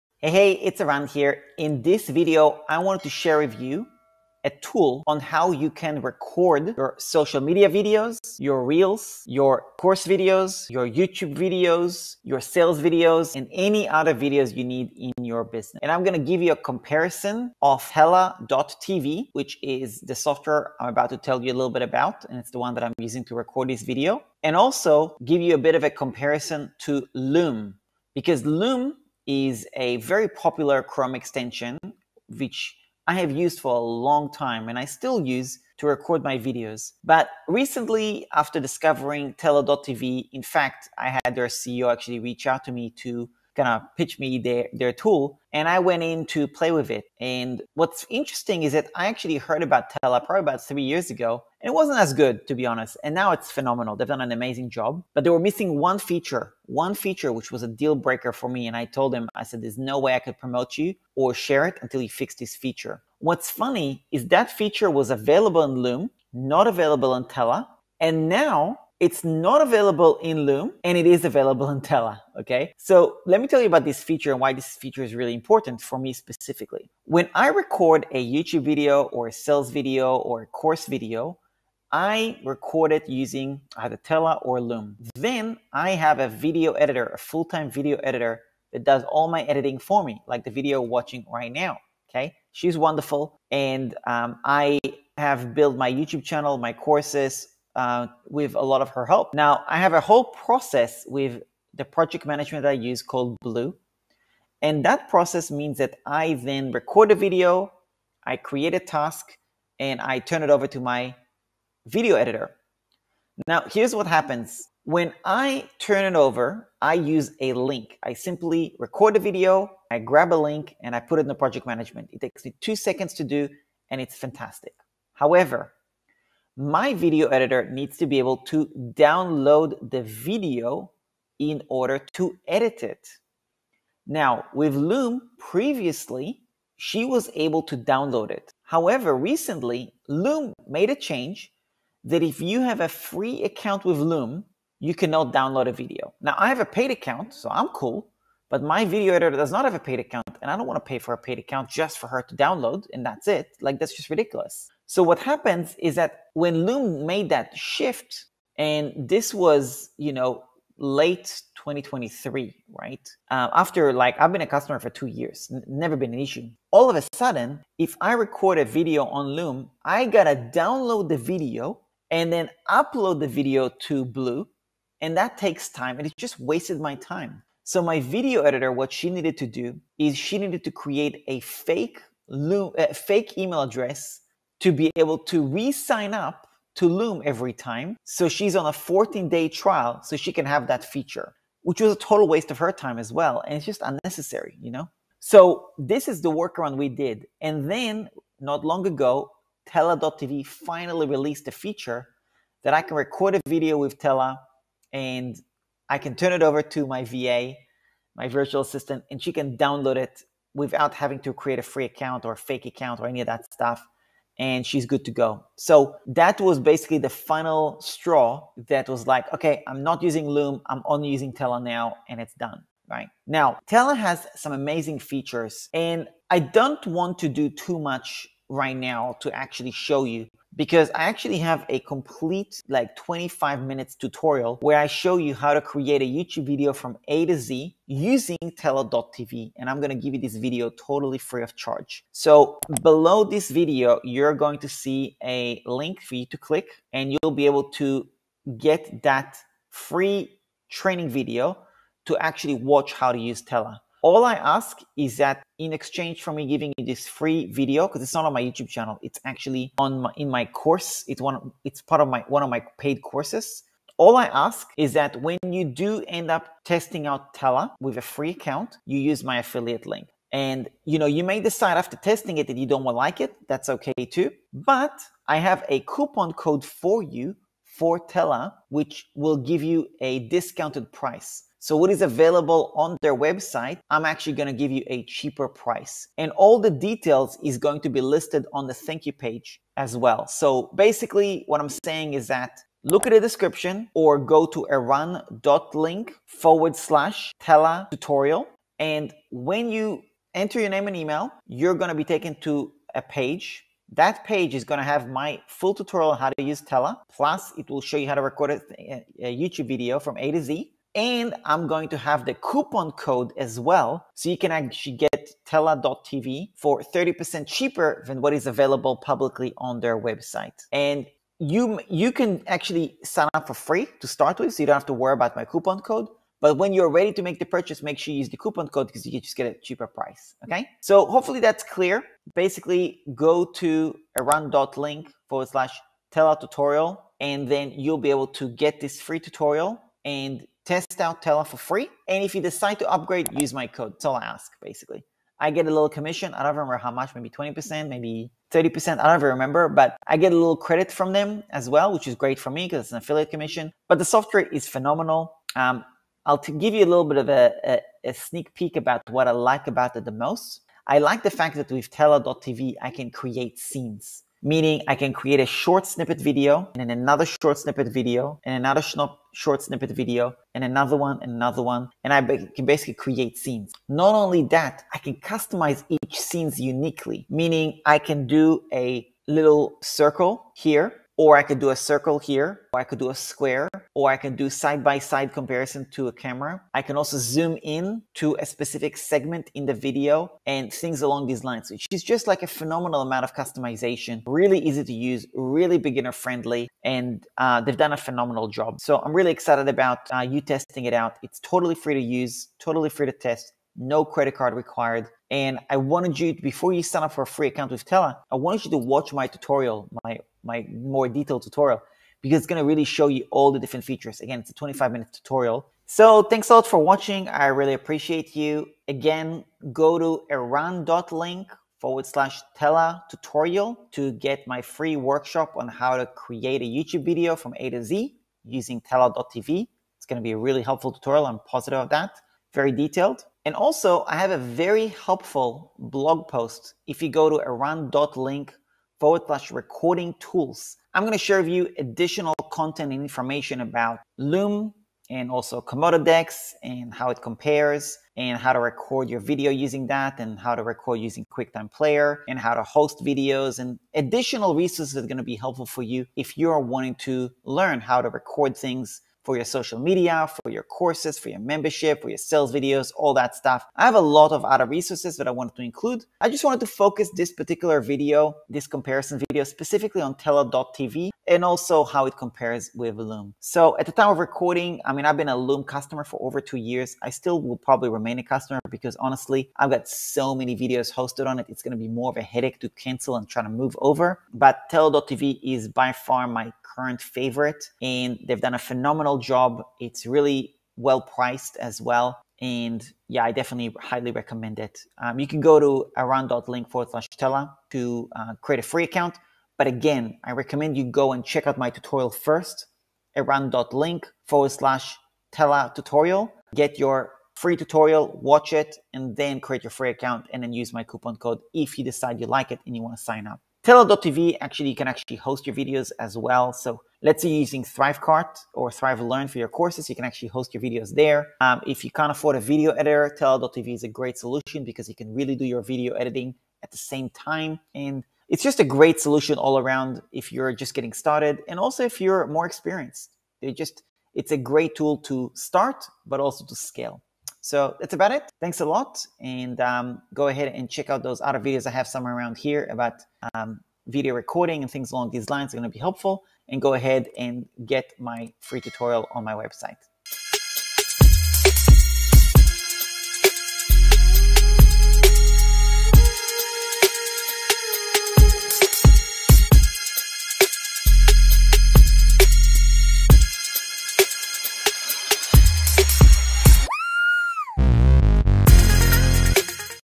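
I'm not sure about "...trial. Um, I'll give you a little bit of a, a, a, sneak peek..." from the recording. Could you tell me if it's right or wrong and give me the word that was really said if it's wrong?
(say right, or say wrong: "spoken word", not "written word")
wrong: "phenomenal", not "trial".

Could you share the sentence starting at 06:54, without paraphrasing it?
Again, it's a 25 minute tutorial.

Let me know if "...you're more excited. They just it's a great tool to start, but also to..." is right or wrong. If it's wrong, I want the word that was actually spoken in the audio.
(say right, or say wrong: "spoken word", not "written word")
wrong: "experienced", not "excited".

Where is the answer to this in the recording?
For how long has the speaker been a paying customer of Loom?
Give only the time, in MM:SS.
07:56.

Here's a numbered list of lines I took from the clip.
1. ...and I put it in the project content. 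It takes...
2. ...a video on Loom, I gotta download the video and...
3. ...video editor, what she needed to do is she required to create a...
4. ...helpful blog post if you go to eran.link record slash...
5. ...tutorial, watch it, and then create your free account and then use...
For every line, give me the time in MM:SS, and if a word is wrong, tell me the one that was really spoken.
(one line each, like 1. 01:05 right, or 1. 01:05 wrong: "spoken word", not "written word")
1. 02:00 wrong: "management", not "content"
2. 02:48 right
3. 02:58 wrong: "needed", not "required"
4. 07:14 wrong: "forward", not "record"
5. 08:27 right.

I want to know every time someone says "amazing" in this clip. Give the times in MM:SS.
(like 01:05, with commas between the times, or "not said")
00:54, 03:44.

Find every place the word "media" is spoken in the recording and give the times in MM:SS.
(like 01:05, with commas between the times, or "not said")
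00:07, 07:39.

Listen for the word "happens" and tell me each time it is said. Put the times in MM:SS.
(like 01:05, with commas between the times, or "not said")
01:54, 02:35.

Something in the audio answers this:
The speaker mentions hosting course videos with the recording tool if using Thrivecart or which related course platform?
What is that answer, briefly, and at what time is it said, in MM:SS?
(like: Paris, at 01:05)
ThriveLearn, at 08:38.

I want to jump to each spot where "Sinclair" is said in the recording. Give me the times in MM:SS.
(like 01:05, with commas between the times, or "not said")
not said.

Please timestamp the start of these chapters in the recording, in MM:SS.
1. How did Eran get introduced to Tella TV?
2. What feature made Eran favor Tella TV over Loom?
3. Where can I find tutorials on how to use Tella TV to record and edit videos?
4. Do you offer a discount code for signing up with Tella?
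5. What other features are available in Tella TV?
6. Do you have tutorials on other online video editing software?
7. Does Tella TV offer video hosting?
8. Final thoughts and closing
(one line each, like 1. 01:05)
1. 00:37
2. 01:13
3. 03:43
4. 04:34
5. 05:55
6. 07:13
7. 08:33
8. 08:57.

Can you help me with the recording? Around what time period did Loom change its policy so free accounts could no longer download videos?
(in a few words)
late 2023.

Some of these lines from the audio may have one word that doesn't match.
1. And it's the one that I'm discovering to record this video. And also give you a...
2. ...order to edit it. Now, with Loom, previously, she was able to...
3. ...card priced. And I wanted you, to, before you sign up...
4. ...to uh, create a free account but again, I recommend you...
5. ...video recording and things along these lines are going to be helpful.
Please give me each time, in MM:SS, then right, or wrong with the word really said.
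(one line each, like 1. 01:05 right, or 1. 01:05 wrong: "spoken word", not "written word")
1. 00:22 wrong: "using", not "discovering"
2. 02:11 right
3. 06:44 wrong: "required", not "priced"
4. 08:17 right
5. 09:03 right.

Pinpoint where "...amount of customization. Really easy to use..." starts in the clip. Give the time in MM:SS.
06:33.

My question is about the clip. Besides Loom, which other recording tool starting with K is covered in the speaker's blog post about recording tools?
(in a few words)
Komodo Decks.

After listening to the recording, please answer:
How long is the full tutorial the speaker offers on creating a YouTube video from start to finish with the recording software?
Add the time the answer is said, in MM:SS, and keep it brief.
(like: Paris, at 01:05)
25 minutes, at 03:52.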